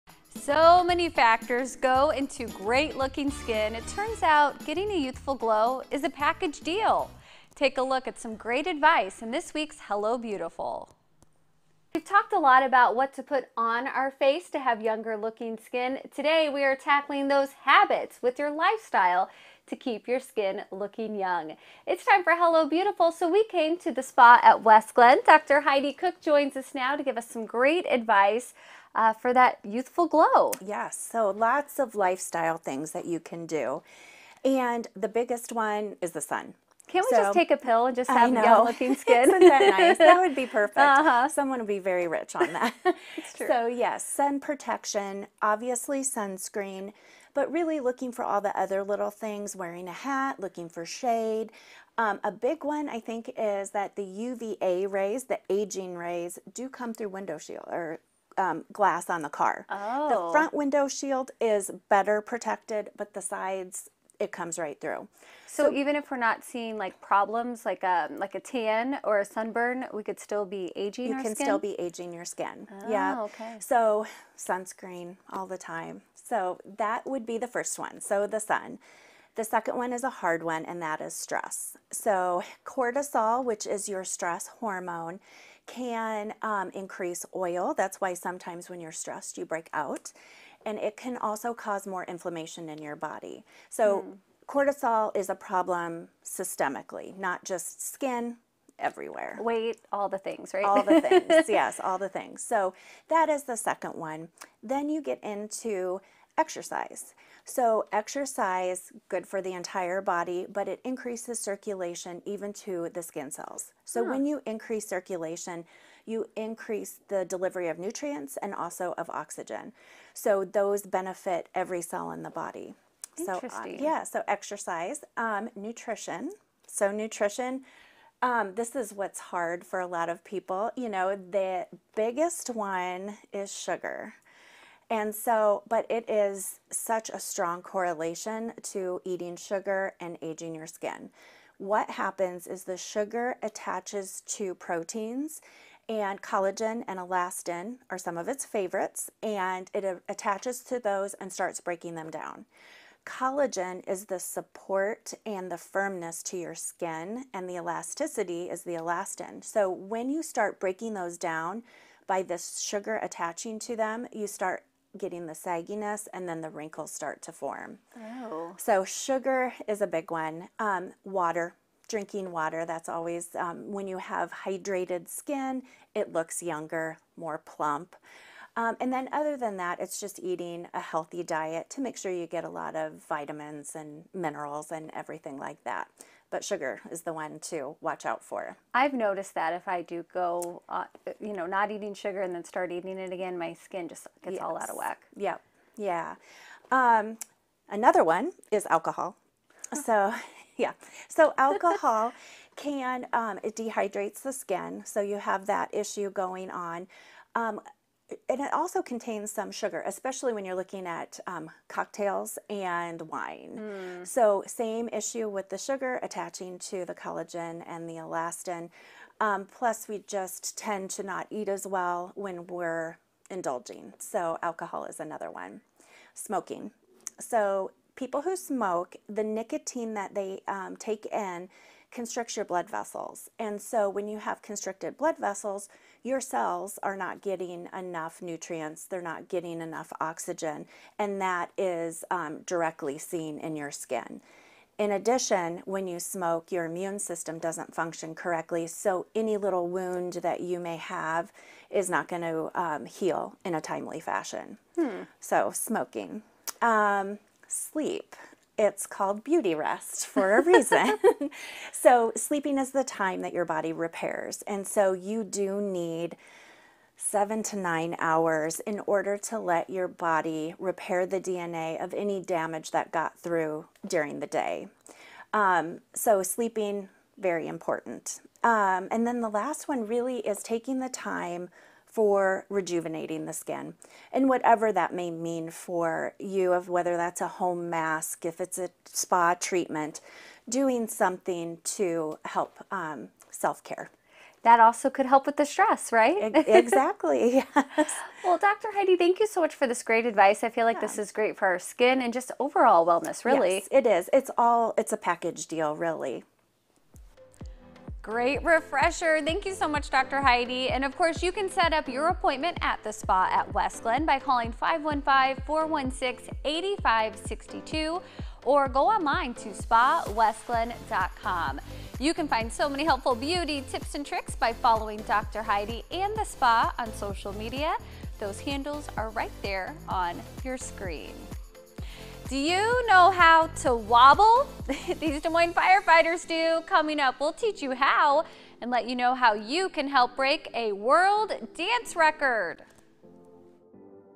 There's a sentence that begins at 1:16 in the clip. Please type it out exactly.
So that would be the first one.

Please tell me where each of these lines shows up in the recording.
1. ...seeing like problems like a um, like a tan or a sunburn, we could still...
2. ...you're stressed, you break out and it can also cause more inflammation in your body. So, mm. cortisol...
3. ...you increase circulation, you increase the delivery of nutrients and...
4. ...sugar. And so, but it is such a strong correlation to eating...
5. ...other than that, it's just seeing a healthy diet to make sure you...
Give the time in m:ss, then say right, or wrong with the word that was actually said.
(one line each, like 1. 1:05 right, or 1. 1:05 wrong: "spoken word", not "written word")
1. 1:06 right
2. 1:28 right
3. 1:54 right
4. 2:13 right
5. 2:59 wrong: "eating", not "seeing".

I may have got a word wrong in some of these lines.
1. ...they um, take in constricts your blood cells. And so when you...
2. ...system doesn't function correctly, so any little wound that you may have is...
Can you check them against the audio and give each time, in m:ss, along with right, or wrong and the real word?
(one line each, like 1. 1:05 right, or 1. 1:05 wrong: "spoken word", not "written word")
1. 3:50 wrong: "vessels", not "cells"
2. 4:06 right.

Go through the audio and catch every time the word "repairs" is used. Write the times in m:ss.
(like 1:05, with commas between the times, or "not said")
4:23, 4:30.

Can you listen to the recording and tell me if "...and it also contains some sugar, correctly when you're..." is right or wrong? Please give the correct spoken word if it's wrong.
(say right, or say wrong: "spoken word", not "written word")
wrong: "especially", not "correctly".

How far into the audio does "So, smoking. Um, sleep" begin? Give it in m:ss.
4:15.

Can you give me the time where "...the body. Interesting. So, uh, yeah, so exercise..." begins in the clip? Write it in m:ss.
2:02.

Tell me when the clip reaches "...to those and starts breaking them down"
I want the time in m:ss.
2:30.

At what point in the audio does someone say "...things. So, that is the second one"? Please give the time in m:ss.
1:42.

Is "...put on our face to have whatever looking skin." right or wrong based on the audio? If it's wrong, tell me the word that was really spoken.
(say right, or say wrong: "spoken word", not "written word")
wrong: "younger", not "whatever".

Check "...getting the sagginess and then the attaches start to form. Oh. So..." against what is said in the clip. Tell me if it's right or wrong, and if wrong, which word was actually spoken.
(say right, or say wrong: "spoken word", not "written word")
wrong: "wrinkles", not "attaches".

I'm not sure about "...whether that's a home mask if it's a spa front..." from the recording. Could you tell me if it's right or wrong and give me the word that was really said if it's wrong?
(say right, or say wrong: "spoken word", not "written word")
wrong: "treatment", not "front".